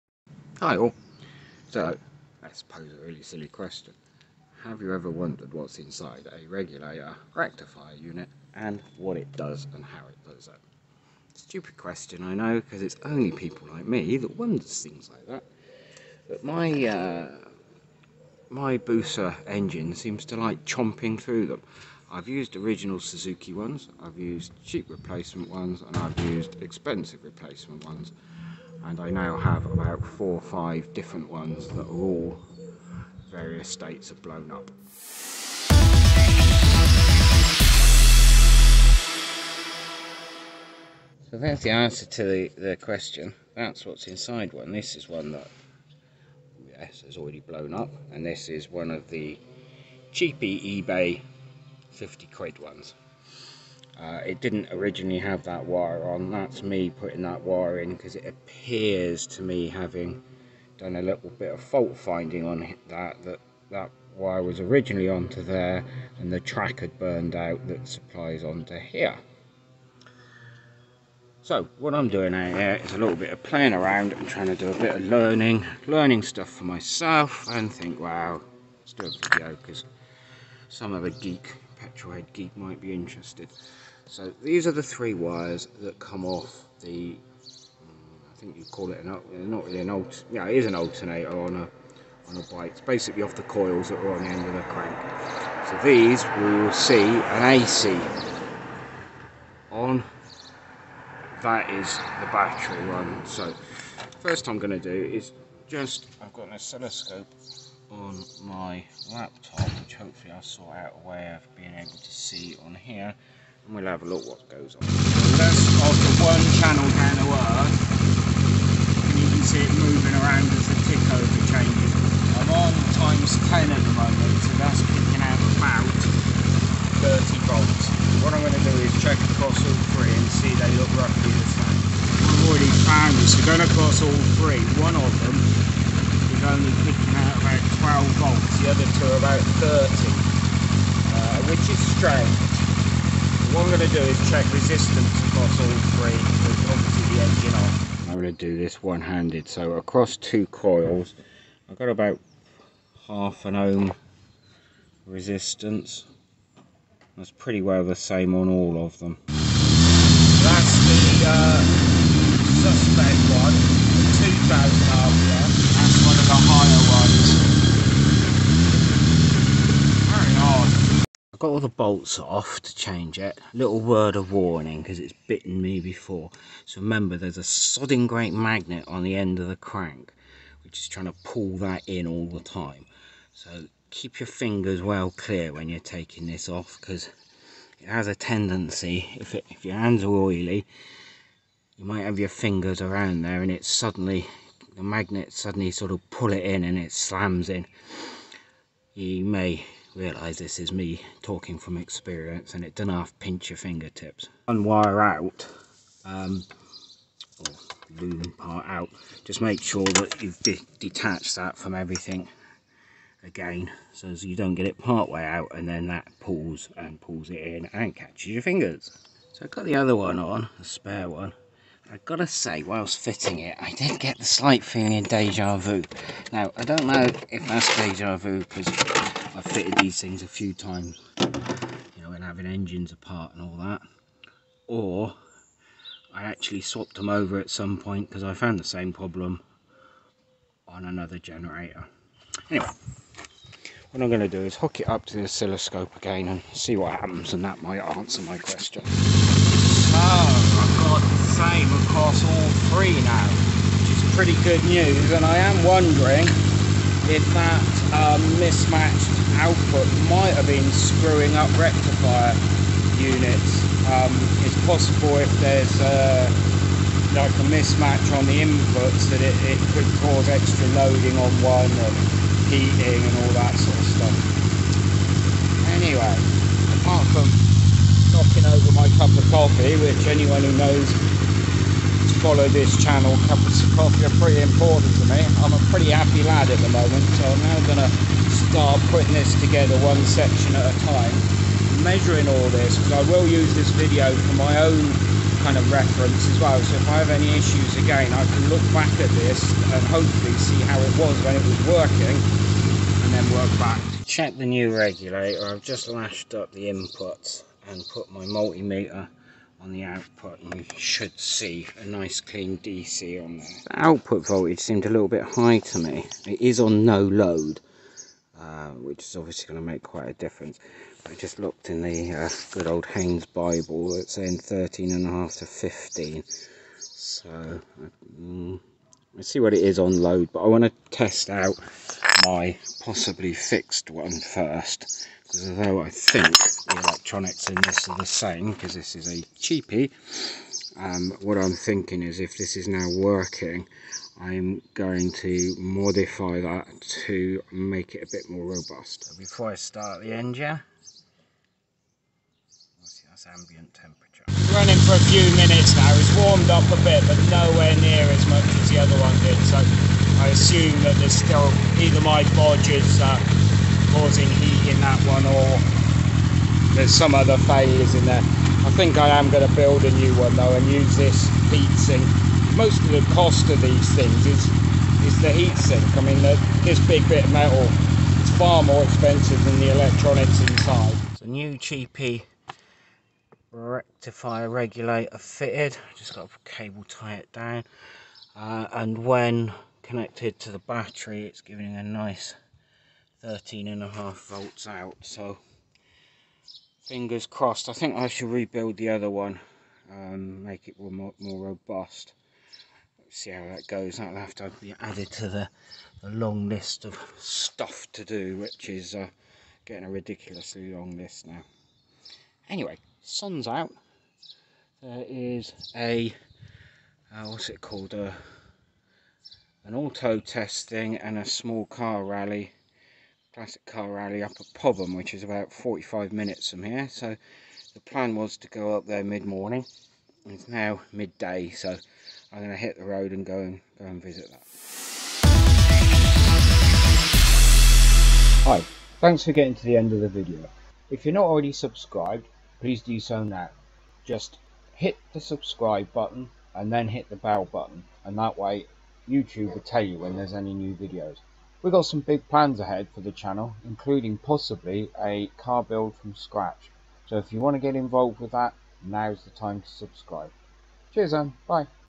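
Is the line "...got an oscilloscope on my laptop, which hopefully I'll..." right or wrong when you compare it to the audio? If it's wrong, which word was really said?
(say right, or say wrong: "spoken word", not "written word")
right.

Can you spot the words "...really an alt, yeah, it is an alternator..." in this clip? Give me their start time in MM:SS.
01:29.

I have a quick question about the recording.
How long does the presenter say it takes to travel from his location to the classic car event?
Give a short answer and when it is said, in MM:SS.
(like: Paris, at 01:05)
45 minutes, at 07:05.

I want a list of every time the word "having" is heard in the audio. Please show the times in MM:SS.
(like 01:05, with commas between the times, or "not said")
00:59, 03:52.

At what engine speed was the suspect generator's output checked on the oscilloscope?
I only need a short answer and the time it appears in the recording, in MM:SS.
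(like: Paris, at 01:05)
2000 RPM, at 02:44.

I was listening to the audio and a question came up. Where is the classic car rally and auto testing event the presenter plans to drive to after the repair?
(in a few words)
Popham.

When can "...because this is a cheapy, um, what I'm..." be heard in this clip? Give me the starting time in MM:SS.
05:38.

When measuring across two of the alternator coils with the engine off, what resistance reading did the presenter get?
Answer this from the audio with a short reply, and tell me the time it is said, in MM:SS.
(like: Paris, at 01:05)
half an ohm, at 02:33.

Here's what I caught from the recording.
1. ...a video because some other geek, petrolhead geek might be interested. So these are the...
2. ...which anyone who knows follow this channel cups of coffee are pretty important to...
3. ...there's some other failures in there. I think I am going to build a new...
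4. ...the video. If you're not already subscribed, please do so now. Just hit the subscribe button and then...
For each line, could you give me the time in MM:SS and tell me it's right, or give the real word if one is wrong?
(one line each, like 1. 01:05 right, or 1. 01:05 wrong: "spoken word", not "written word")
1. 01:19 right
2. 04:39 right
3. 06:06 right
4. 07:19 right.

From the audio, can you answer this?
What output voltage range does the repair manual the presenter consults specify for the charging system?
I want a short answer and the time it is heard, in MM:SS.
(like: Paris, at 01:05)
13.5 to 15, at 05:24.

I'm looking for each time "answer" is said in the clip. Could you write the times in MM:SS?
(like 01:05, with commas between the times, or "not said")
00:41, 04:07.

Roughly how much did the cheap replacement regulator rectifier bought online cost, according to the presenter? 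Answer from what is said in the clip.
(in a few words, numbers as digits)
£50.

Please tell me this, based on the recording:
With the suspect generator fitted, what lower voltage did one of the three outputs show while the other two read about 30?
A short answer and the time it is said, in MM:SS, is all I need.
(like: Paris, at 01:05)
12 volts, at 02:18.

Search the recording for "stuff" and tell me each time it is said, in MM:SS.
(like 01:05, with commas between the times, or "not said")
01:16, 04:33, 06:47.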